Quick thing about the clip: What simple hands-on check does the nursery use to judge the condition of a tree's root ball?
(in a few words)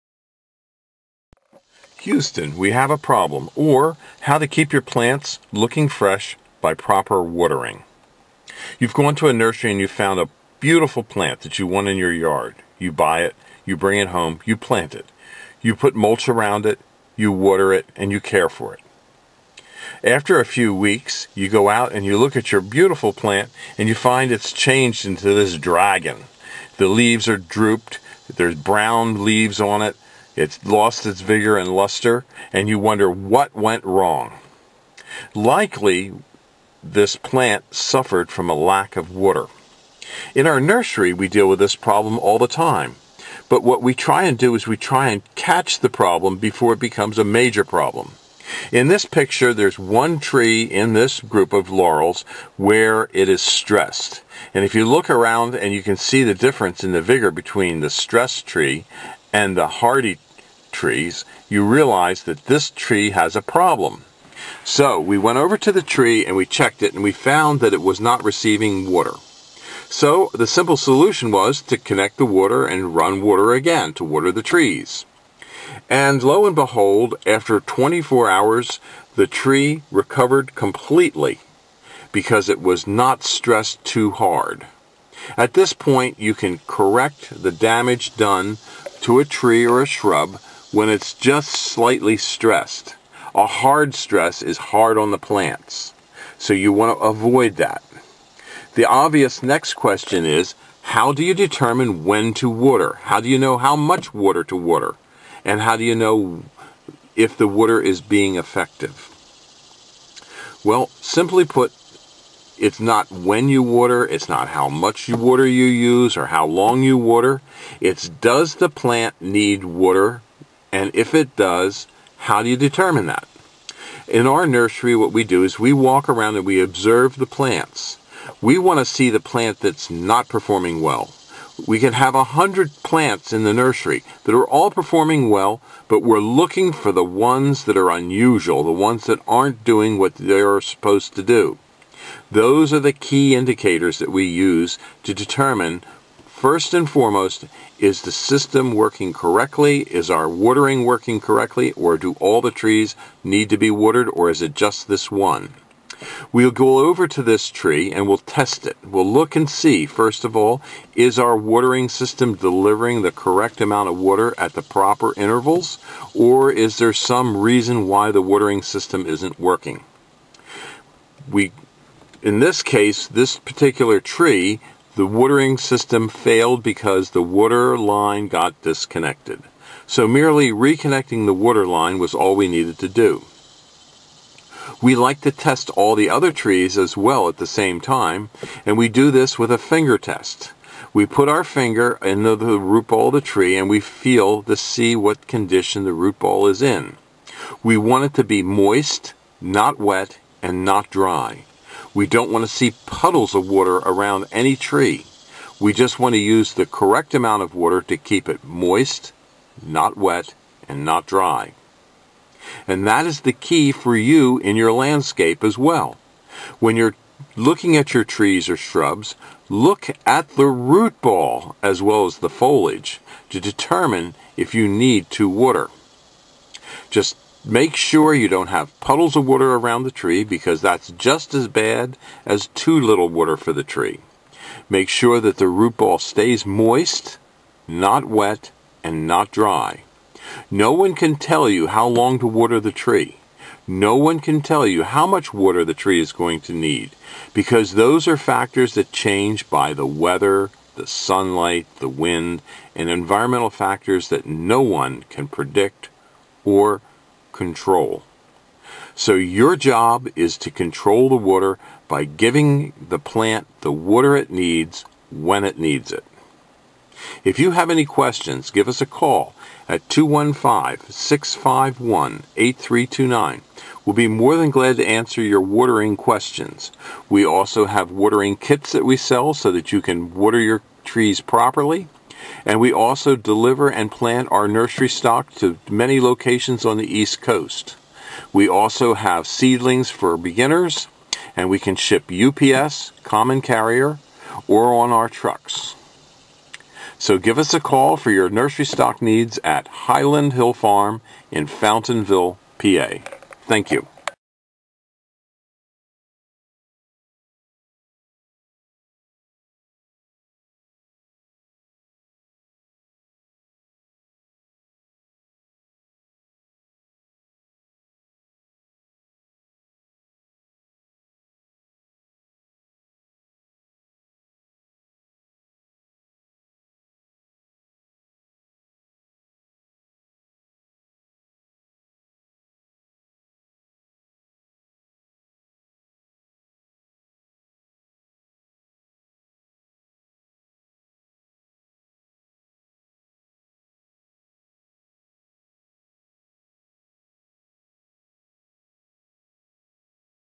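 finger test.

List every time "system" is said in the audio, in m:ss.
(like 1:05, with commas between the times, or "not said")
2:28, 2:41, 2:48, 2:55.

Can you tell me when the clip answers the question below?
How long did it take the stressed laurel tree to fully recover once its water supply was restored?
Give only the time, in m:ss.
1:17.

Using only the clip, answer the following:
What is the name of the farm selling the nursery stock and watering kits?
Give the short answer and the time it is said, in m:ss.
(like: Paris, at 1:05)
Highland Hill Farm, at 4:59.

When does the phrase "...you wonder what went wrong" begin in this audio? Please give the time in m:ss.
0:32.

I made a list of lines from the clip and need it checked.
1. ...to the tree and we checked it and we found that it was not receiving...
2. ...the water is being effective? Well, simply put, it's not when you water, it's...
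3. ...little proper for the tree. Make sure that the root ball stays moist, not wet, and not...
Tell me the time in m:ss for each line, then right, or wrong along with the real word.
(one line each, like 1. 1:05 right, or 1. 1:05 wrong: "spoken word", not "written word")
1. 1:05 right
2. 1:47 right
3. 3:52 wrong: "water", not "proper".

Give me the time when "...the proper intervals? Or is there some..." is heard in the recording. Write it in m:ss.
2:44.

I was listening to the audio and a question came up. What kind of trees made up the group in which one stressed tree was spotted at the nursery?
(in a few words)
laurels.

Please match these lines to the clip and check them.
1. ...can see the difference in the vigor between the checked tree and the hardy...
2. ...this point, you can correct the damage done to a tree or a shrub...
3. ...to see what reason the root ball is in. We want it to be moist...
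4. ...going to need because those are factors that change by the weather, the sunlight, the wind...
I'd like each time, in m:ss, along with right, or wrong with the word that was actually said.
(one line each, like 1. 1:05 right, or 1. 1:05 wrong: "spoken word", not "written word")
1. 0:55 wrong: "stressed", not "checked"
2. 1:25 right
3. 3:14 wrong: "condition", not "reason"
4. 4:06 right.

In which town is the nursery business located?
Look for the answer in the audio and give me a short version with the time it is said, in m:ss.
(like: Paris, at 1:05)
Fountainville, PA, at 5:01.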